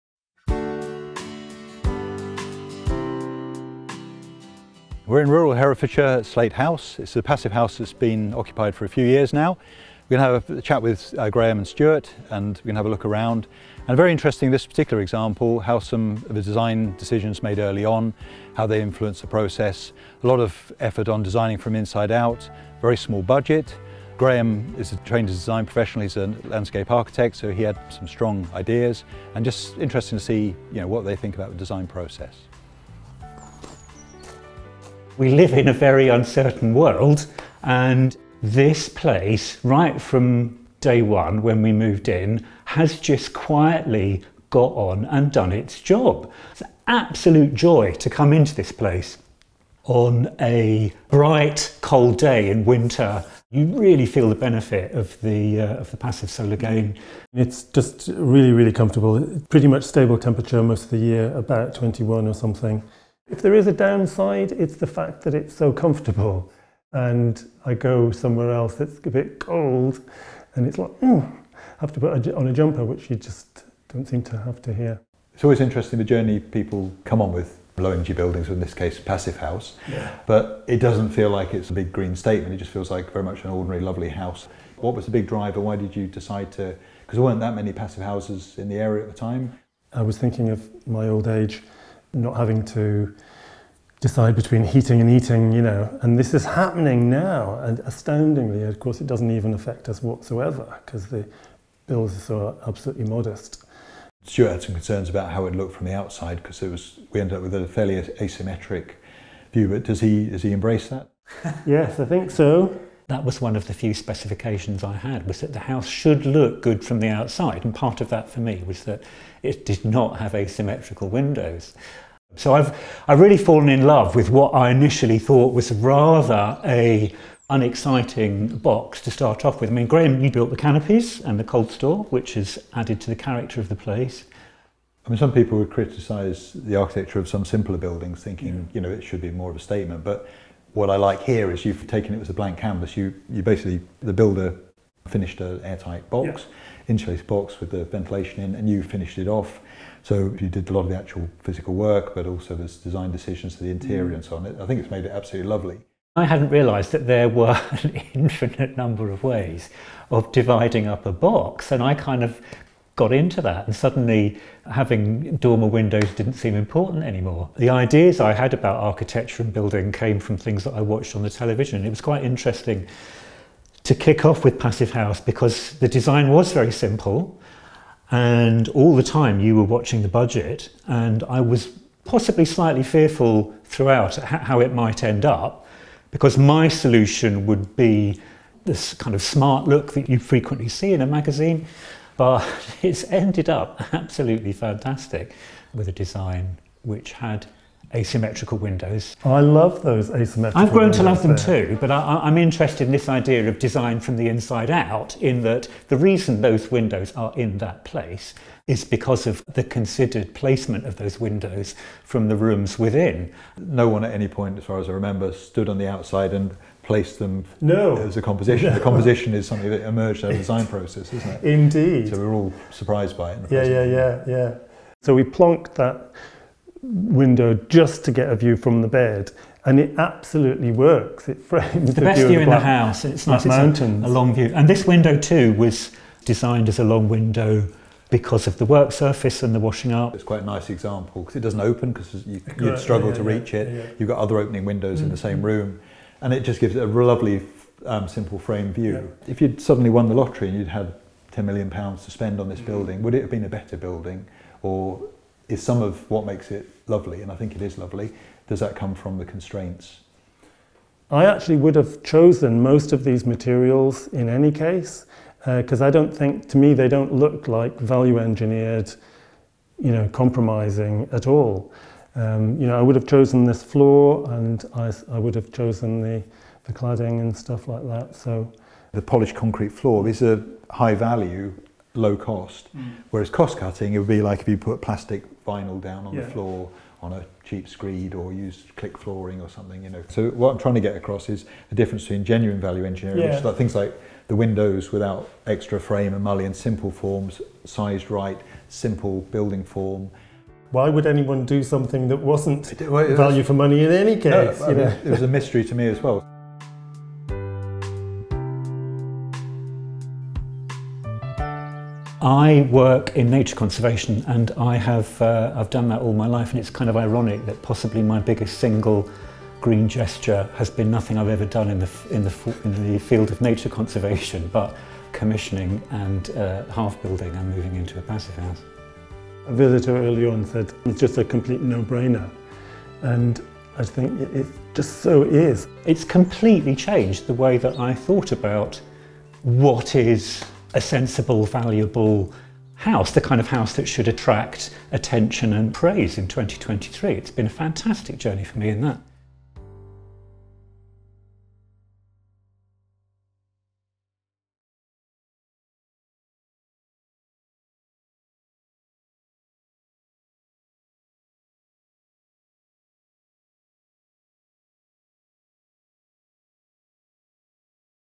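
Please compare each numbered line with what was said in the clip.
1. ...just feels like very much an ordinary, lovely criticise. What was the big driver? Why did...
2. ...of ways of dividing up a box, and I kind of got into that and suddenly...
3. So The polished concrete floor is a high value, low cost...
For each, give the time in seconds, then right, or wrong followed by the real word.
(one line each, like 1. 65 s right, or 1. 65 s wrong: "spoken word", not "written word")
1. 82 s wrong: "house", not "criticise"
2. 159 s right
3. 278 s right.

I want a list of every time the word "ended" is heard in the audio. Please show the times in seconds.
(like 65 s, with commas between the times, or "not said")
107 s, 193 s.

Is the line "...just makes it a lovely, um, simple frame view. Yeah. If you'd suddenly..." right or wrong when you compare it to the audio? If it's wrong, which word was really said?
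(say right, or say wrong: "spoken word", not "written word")
wrong: "gives", not "makes".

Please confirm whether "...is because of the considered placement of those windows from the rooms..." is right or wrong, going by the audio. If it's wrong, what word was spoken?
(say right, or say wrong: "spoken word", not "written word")
right.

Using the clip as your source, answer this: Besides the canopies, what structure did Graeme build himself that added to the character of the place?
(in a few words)
The cold store.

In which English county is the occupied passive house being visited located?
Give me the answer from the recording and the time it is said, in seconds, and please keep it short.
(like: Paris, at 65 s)
Herefordshire, at 5 s.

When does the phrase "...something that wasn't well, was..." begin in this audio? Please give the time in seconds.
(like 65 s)
301 s.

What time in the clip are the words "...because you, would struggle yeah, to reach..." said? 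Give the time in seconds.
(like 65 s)
241 s.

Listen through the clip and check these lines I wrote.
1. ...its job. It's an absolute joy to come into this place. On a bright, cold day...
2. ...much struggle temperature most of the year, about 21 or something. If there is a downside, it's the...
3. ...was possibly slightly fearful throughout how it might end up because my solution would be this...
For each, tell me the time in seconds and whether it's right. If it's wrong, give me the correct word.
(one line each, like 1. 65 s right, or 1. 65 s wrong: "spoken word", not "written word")
1. 45 s right
2. 59 s wrong: "stable", not "struggle"
3. 181 s right.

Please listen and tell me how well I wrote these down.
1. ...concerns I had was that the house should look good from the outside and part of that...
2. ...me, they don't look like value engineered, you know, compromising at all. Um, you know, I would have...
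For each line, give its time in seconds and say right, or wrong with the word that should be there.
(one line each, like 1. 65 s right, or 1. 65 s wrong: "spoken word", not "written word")
1. 113 s wrong: "specifications", not "concerns"
2. 266 s right.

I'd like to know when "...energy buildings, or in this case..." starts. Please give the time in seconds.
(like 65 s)
77 s.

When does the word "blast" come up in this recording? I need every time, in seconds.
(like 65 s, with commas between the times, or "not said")
not said.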